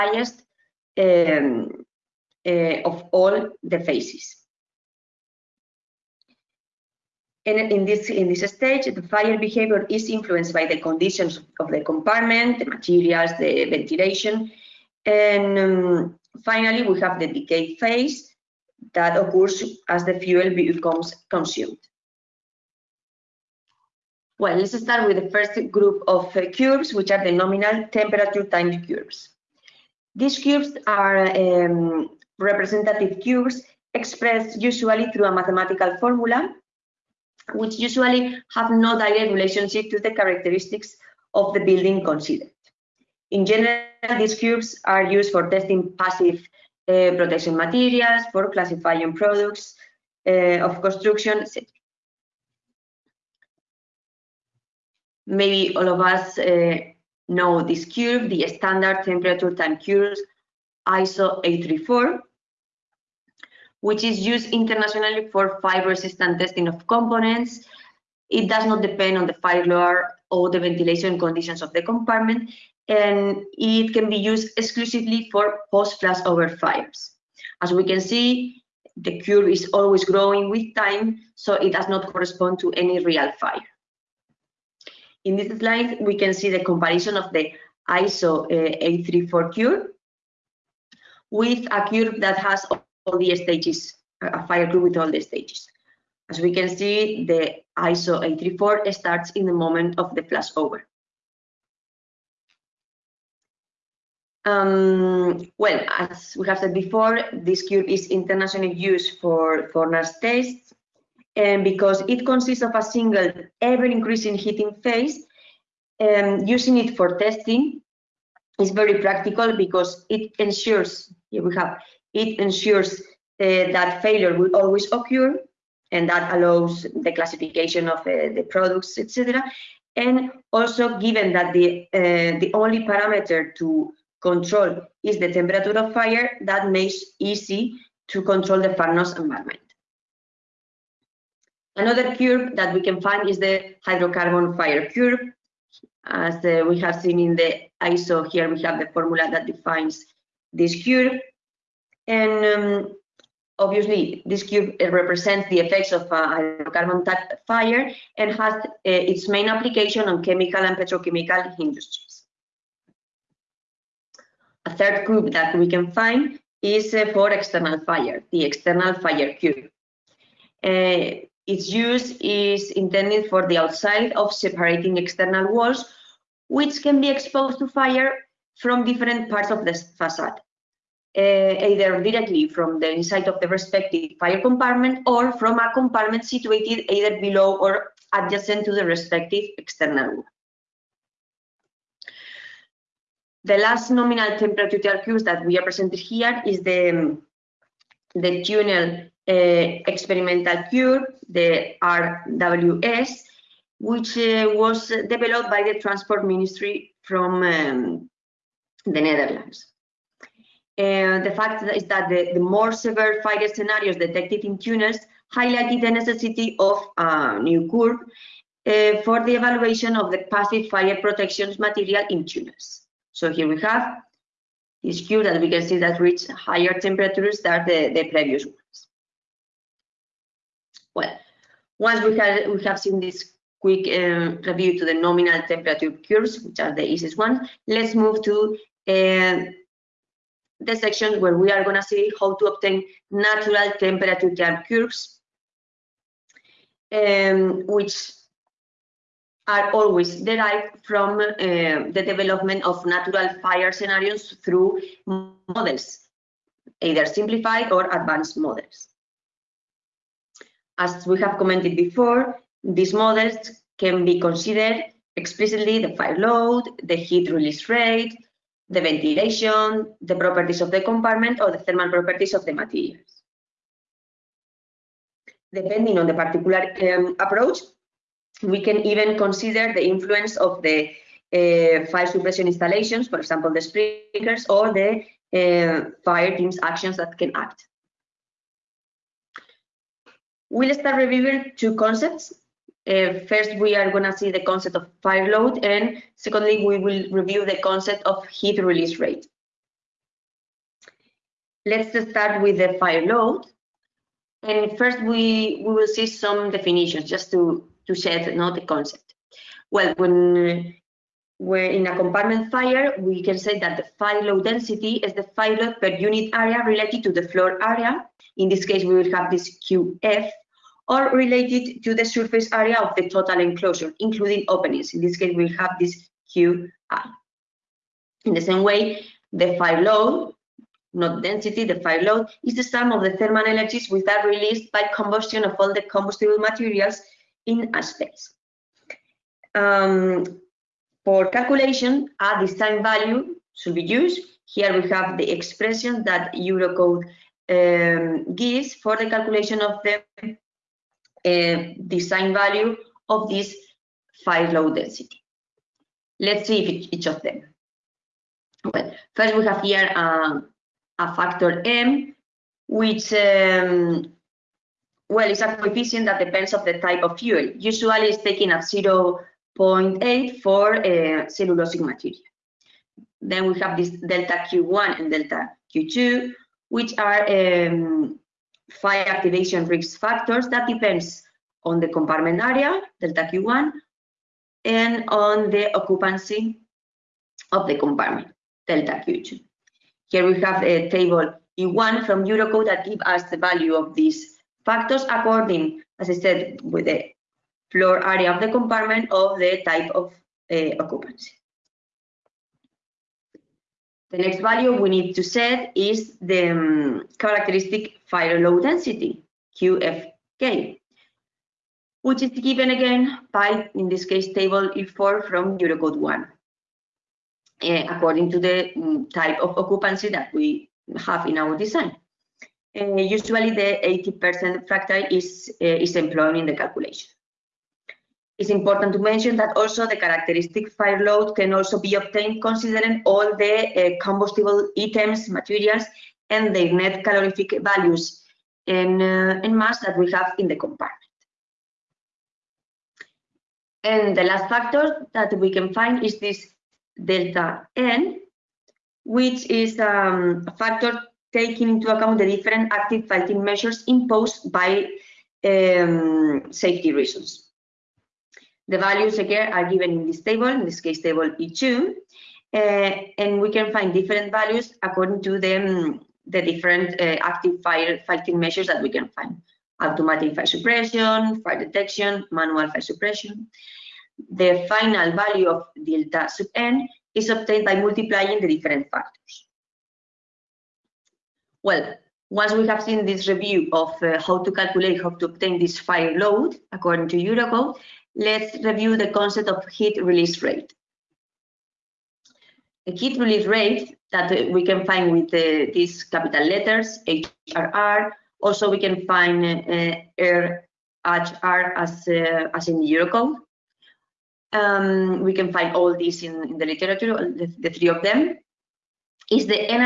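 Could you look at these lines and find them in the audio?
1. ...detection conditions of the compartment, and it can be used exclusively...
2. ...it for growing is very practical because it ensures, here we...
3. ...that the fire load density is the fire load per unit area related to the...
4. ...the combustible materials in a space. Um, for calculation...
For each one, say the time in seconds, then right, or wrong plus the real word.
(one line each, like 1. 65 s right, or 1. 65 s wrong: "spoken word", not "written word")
1. 70 s wrong: "ventilation", not "detection"
2. 116 s wrong: "testing", not "growing"
3. 313 s right
4. 335 s right.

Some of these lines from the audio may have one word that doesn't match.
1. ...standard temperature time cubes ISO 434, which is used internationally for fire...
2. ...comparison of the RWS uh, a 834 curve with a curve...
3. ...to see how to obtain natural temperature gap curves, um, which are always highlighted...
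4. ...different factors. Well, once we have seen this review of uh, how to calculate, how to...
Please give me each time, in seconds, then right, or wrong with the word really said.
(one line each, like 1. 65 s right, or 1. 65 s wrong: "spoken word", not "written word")
1. 58 s wrong: "834", not "434"
2. 86 s wrong: "ISO", not "RWS"
3. 241 s wrong: "derived", not "highlighted"
4. 478 s right.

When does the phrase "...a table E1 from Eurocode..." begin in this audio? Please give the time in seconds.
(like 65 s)
390 s.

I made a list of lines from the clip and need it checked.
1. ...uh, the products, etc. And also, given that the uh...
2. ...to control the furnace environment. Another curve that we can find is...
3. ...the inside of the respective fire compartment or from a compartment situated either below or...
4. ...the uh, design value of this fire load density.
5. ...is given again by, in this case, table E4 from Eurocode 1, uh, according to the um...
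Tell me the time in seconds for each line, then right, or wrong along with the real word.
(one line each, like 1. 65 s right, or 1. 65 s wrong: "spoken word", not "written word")
1. 127 s right
2. 138 s right
3. 182 s right
4. 349 s right
5. 412 s right.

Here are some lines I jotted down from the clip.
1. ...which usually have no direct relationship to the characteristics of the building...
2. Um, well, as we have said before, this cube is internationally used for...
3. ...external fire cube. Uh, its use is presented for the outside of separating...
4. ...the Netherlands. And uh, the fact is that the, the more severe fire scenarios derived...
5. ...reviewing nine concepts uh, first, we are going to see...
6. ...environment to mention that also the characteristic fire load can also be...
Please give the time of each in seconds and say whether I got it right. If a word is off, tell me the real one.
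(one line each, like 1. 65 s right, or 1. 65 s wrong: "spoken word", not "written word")
1. 37 s right
2. 104 s right
3. 168 s wrong: "intended", not "presented"
4. 208 s wrong: "detected", not "derived"
5. 290 s wrong: "two", not "nine"
6. 428 s wrong: "important", not "environment".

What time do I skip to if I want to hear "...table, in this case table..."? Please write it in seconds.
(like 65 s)
460 s.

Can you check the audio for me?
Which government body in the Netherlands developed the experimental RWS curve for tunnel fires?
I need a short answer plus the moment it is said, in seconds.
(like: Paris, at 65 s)
Transport Ministry, at 205 s.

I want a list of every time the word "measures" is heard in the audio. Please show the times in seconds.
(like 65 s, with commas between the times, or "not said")
453 s, 468 s.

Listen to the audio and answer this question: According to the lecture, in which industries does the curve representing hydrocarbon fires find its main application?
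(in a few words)
chemical and petrochemical.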